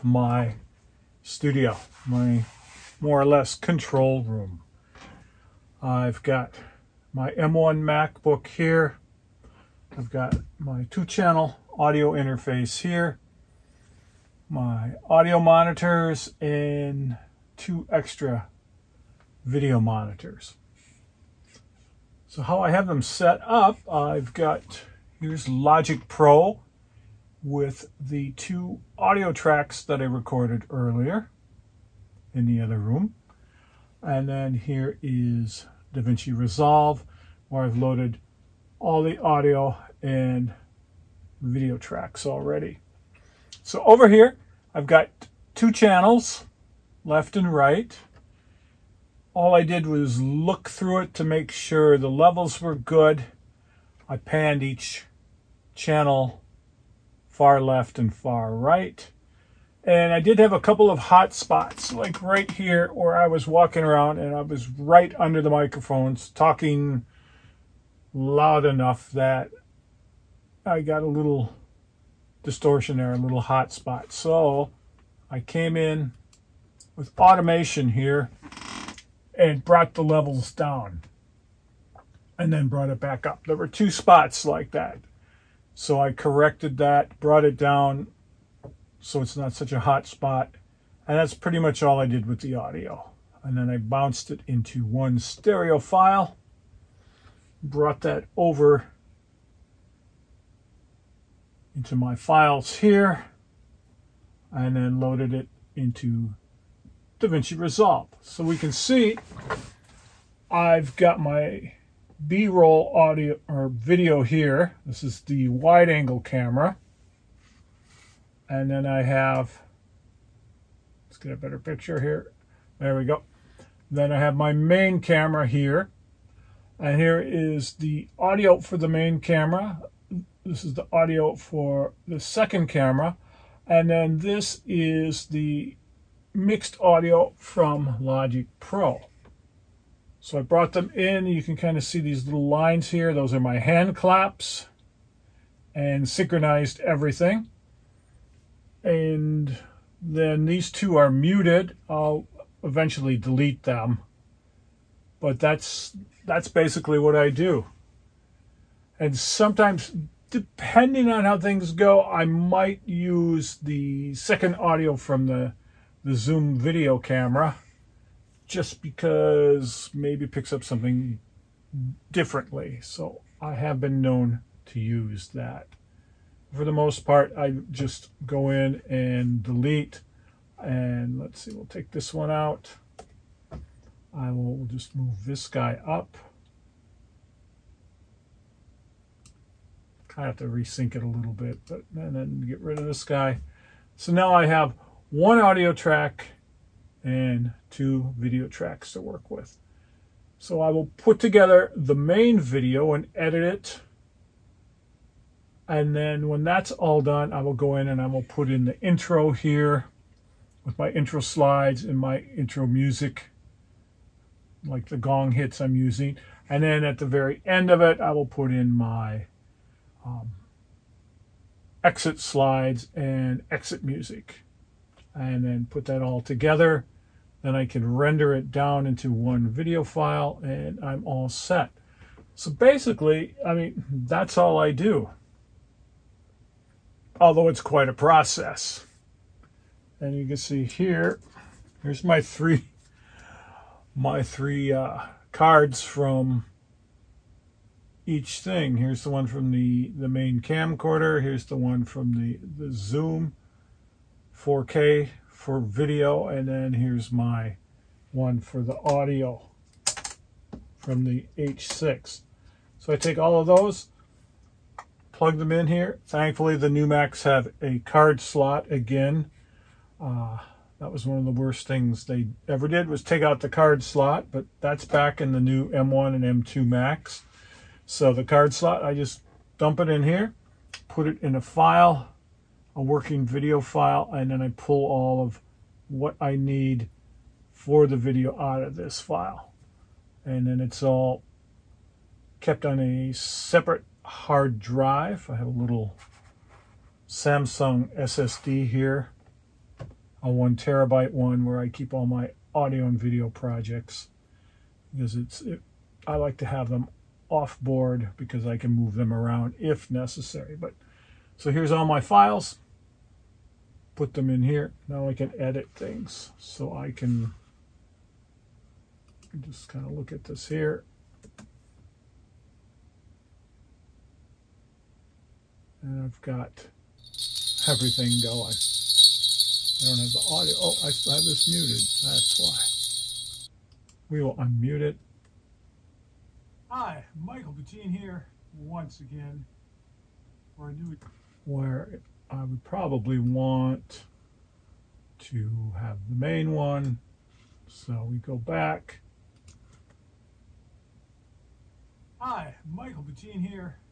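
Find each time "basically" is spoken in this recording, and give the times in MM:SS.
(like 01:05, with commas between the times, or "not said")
02:36, 03:52.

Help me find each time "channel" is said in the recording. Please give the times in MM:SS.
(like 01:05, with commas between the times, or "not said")
00:11, 00:45, 00:55.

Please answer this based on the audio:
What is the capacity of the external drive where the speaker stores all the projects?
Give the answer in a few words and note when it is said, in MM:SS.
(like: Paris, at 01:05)
1 terabyte, at 05:00.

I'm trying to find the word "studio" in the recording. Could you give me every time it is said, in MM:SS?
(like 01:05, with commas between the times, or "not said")
00:01.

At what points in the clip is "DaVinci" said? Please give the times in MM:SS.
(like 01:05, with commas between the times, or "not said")
00:35, 01:47.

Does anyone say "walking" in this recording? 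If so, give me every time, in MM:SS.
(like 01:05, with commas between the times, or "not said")
01:03.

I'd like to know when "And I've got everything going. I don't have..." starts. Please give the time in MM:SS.
05:25.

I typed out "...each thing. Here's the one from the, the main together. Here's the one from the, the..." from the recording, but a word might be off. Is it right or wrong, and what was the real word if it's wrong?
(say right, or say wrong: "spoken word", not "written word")
wrong: "camcorder", not "together".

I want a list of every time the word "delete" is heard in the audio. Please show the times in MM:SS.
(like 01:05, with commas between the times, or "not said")
02:33, 02:59.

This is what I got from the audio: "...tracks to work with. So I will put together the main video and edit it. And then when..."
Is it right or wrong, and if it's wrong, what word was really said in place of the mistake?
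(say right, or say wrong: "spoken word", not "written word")
right.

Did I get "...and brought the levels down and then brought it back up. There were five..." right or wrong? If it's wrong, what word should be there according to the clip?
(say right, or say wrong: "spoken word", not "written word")
wrong: "two", not "five".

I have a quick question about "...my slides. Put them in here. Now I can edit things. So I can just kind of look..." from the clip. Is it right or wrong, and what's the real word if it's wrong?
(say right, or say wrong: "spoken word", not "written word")
wrong: "files", not "slides".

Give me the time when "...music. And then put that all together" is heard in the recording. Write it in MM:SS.
03:43.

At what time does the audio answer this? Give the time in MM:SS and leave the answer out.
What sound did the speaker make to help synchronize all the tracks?
02:23.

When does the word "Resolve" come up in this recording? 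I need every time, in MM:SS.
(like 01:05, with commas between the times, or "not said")
00:36, 01:47.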